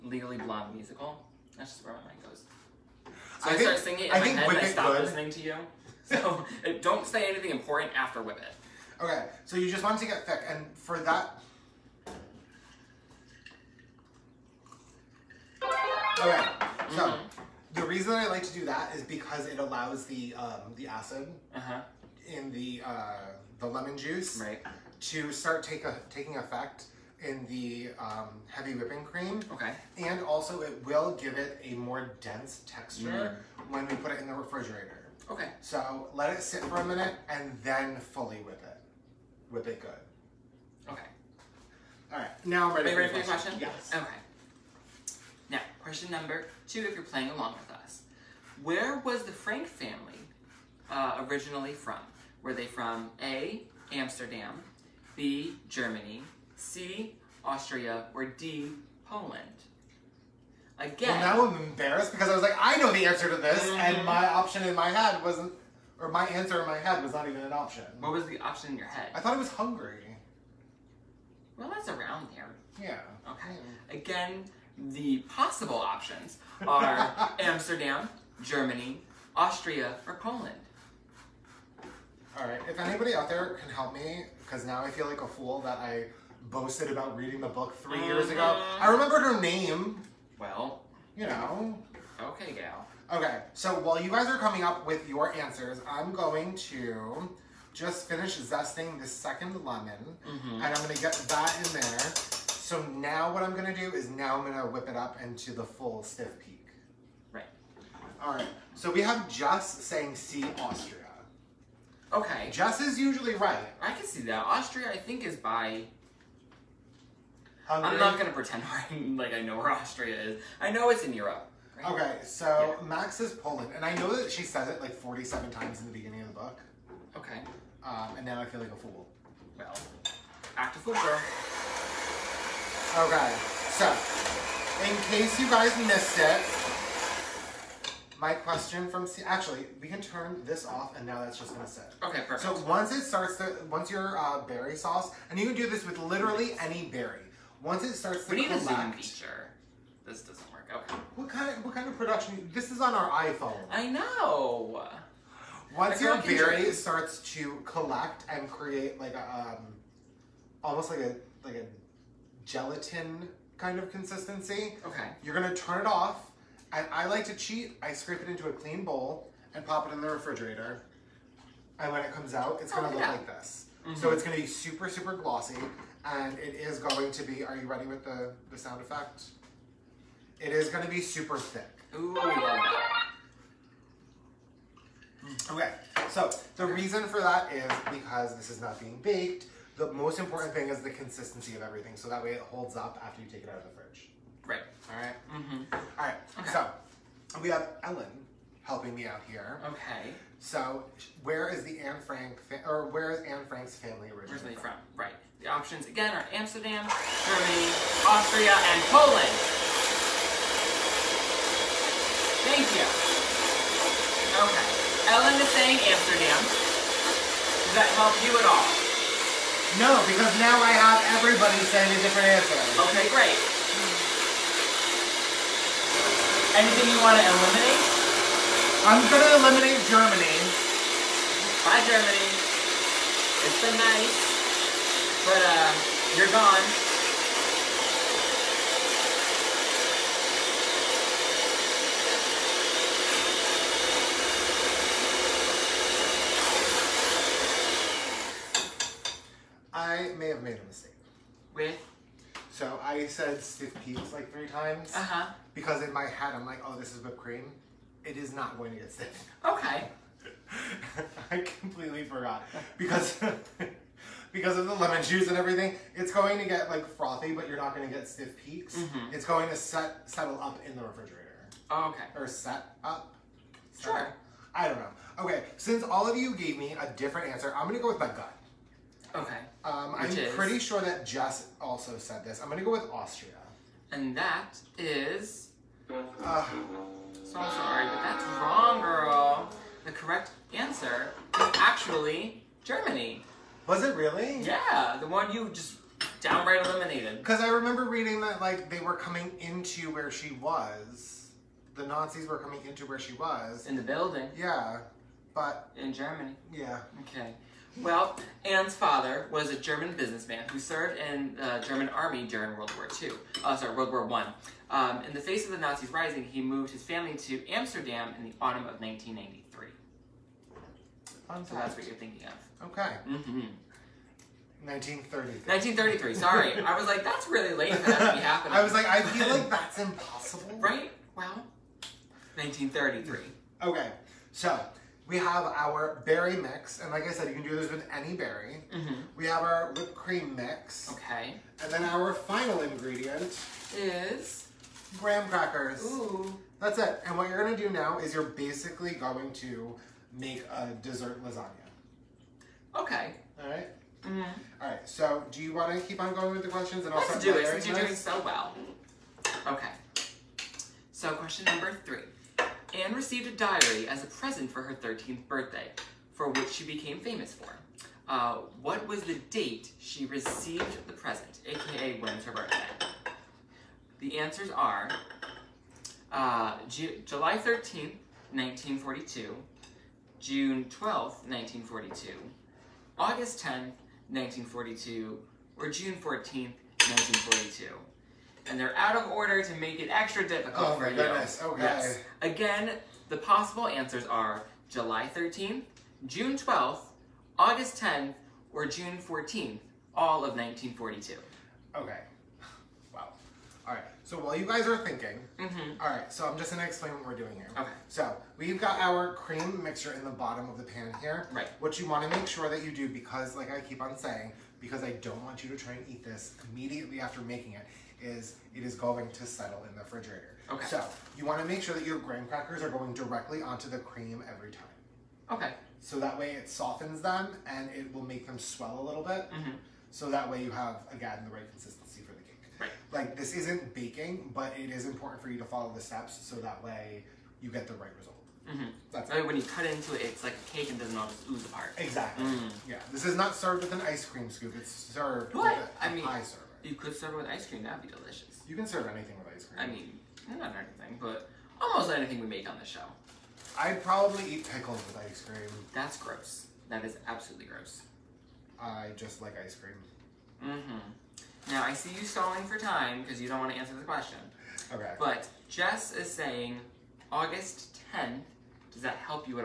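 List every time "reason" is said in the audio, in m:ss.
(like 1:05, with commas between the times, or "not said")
0:17, 3:06.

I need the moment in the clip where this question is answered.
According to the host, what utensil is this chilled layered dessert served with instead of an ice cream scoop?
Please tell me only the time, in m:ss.
7:26.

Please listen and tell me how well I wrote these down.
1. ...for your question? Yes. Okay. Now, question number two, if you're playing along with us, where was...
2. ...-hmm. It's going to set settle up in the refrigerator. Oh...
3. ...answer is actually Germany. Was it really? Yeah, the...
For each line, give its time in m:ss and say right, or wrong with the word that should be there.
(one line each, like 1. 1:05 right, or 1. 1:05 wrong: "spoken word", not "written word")
1. 0:43 right
2. 4:28 right
3. 4:50 right.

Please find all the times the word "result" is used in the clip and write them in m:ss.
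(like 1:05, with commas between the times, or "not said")
7:18.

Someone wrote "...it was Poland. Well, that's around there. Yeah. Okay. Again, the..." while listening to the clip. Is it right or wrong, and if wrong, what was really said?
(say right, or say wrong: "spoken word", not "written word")
wrong: "Hungary", not "Poland".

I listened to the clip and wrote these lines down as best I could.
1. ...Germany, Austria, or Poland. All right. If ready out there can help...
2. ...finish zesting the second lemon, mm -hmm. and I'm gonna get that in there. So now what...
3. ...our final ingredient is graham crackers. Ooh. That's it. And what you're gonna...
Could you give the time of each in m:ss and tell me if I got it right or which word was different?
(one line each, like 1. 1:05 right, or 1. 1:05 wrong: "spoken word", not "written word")
1. 1:18 wrong: "anybody", not "ready"
2. 1:38 right
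3. 5:41 right.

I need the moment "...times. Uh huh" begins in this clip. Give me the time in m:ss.
4:14.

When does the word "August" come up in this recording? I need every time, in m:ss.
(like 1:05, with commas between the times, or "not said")
6:22, 6:37, 7:47.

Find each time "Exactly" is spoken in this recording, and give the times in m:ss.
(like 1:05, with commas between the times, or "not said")
7:21.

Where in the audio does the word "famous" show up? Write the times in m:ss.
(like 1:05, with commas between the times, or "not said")
6:06.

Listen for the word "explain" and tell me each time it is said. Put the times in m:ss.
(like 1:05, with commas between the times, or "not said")
6:46.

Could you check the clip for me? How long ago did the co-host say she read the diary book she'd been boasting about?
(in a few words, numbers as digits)
3 years ago.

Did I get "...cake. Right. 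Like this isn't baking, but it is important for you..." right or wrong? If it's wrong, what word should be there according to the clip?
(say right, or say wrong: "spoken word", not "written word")
right.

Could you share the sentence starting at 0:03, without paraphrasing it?
So I, I think, start singing it in I my head and I stop good.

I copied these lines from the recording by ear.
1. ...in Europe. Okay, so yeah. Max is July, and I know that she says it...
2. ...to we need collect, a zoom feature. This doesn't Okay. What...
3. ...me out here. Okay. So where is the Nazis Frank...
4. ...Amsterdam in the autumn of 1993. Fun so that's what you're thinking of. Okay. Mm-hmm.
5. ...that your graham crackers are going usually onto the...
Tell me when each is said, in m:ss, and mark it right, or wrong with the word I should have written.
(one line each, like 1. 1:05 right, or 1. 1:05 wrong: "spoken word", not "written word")
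1. 2:01 wrong: "Poland", not "July"
2. 2:28 right
3. 3:18 wrong: "Anne", not "Nazis"
4. 5:17 right
5. 7:01 wrong: "directly", not "usually".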